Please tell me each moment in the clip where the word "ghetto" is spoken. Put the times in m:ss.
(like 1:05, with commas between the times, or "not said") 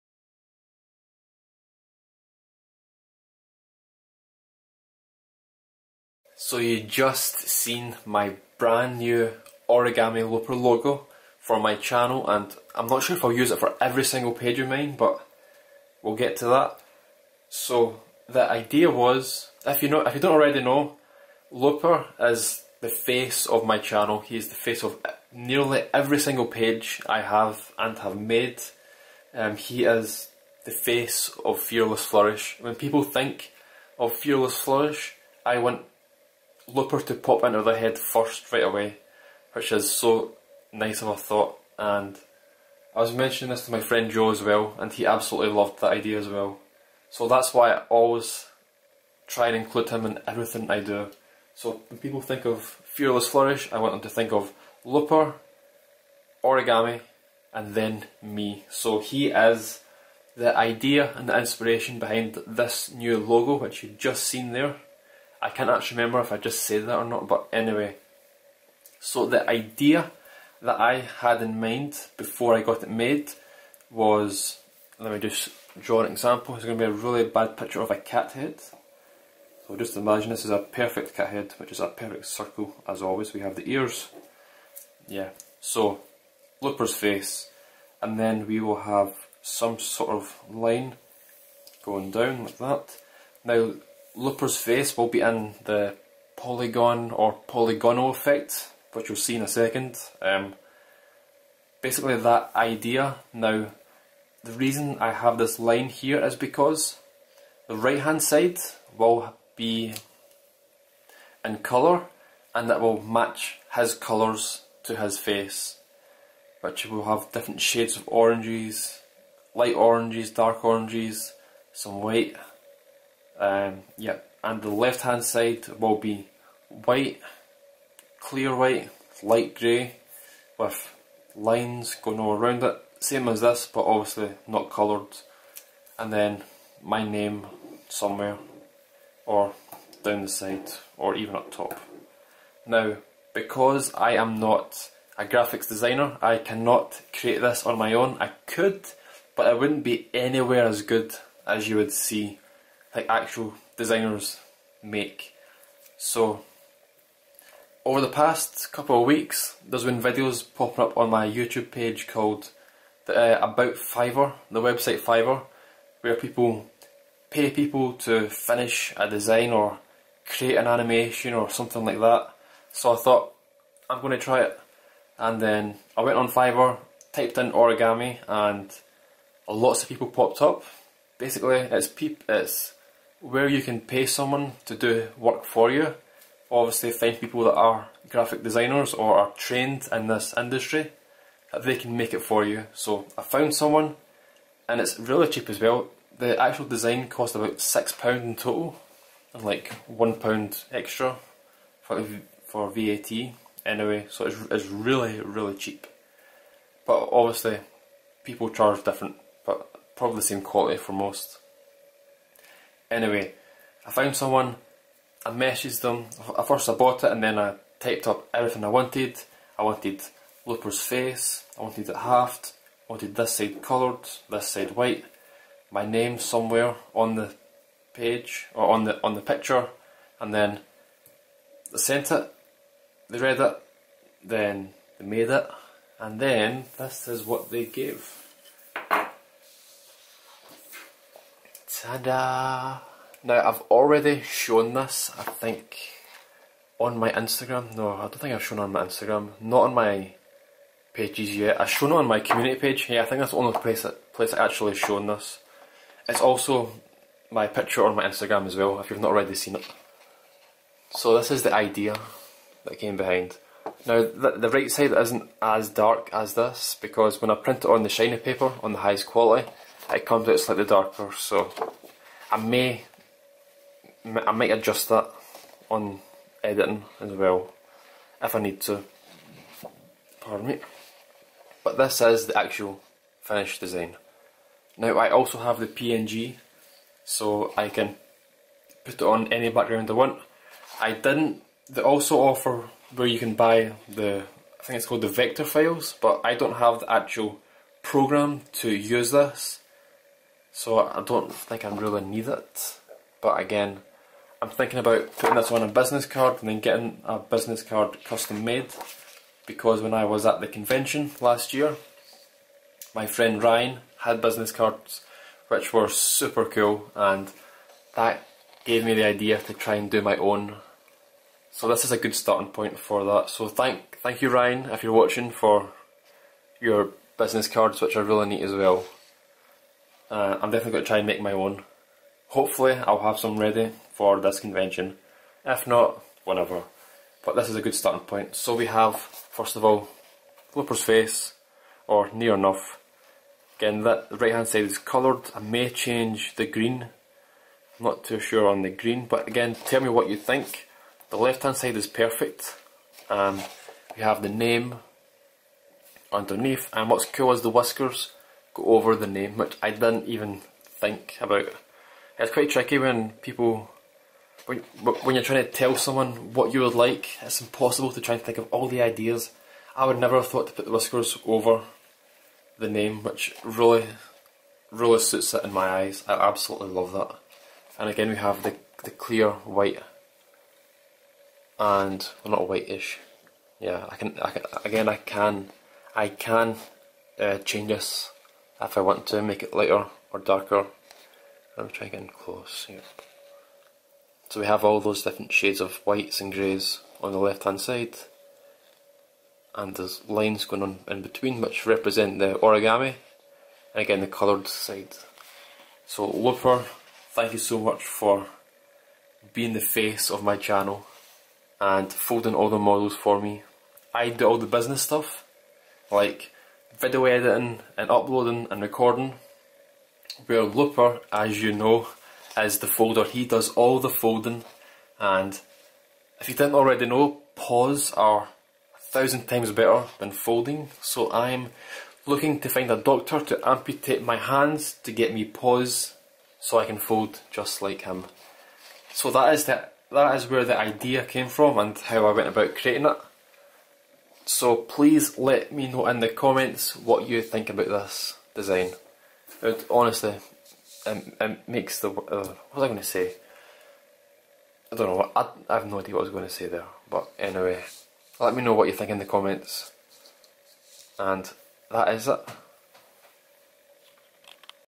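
not said.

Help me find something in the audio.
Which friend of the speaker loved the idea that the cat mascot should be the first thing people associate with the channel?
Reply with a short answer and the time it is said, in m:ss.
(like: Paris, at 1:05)
Joe, at 0:44.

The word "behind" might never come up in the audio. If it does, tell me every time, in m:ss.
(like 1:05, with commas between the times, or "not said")
1:01, 4:22.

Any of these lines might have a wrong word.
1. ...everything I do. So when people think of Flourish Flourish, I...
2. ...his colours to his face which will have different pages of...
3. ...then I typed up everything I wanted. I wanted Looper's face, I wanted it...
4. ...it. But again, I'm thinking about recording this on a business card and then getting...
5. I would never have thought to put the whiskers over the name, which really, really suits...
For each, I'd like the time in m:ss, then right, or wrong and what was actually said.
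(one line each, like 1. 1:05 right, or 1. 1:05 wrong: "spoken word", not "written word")
1. 0:50 wrong: "Fearless", not "Flourish"
2. 1:53 wrong: "shades", not "pages"
3. 3:37 right
4. 5:02 wrong: "putting", not "recording"
5. 6:09 right.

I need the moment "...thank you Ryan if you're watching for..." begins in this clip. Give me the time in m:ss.
5:24.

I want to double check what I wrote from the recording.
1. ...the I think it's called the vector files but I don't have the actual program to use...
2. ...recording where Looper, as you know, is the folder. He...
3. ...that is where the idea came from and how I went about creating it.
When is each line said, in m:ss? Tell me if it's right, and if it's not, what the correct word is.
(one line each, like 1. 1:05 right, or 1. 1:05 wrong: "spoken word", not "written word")
1. 4:53 right
2. 6:58 right
3. 7:19 right.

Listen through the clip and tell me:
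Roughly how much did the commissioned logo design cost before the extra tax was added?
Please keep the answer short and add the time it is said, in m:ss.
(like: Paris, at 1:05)
£6, at 3:17.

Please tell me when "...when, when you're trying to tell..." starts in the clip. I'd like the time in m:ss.
6:04.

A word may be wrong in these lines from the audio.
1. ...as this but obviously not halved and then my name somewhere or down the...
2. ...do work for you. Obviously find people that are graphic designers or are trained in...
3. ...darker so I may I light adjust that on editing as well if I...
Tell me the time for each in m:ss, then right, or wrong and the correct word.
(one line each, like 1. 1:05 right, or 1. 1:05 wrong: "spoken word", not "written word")
1. 2:13 wrong: "coloured", not "halved"
2. 3:04 right
3. 4:30 wrong: "might", not "light".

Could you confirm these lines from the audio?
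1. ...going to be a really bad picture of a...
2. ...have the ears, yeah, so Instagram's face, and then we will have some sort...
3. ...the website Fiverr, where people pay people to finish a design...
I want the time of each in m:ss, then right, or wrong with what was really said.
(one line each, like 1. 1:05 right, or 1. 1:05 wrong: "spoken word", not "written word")
1. 1:16 right
2. 1:23 wrong: "Looper", not "Instagram"
3. 2:44 right.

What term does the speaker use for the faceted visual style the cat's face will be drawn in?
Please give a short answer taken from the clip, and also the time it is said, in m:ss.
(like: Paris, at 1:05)
polygonal effect, at 1:37.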